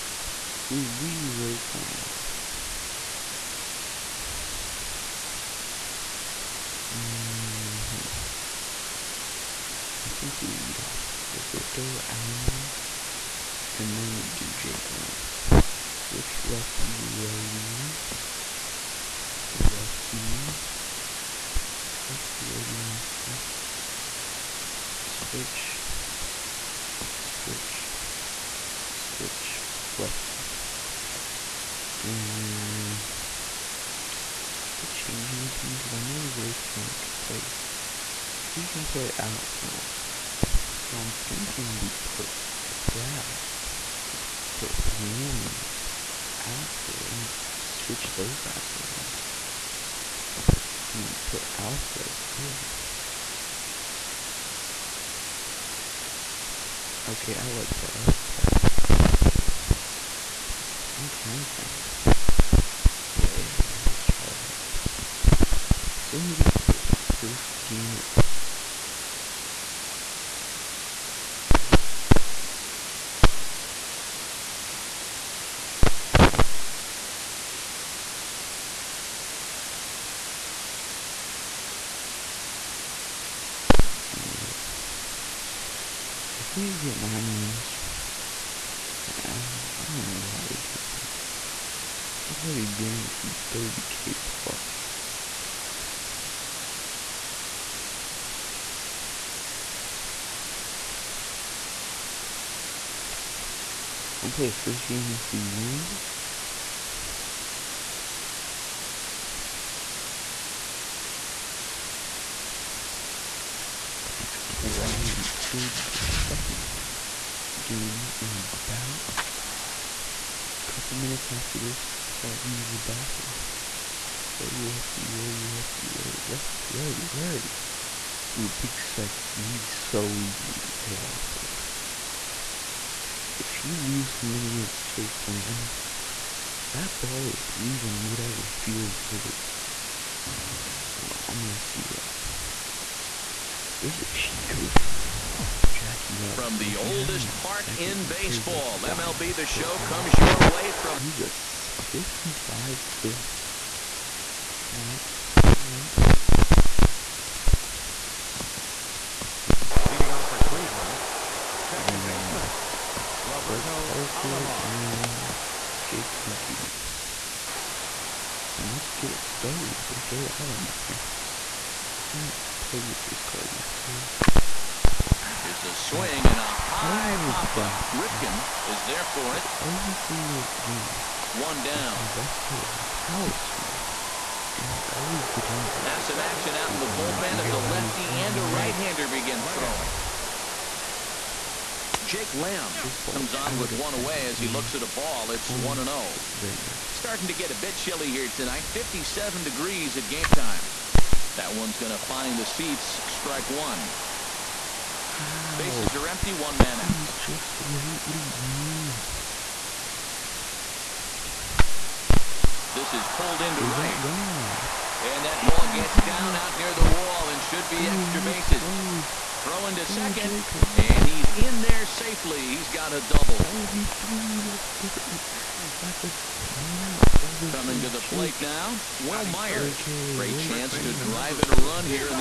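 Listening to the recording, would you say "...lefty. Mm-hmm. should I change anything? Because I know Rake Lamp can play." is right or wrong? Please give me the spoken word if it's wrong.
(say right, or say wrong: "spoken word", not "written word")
right.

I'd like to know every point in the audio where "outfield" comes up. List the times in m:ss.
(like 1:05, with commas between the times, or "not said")
0:39, 0:46.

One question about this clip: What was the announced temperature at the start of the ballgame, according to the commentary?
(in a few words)
57 degrees.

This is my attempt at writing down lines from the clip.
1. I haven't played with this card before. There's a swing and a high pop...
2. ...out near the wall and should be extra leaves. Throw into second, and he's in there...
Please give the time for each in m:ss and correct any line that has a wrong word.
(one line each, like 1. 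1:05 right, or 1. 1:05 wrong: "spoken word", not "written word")
1. 2:52 right
2. 3:36 wrong: "bases", not "leaves".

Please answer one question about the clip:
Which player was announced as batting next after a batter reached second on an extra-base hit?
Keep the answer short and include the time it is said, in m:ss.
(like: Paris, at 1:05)
Wil Myers, at 3:49.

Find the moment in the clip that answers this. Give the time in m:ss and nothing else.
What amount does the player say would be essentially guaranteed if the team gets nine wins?
1:33.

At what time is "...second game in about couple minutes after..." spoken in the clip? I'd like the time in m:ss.
1:56.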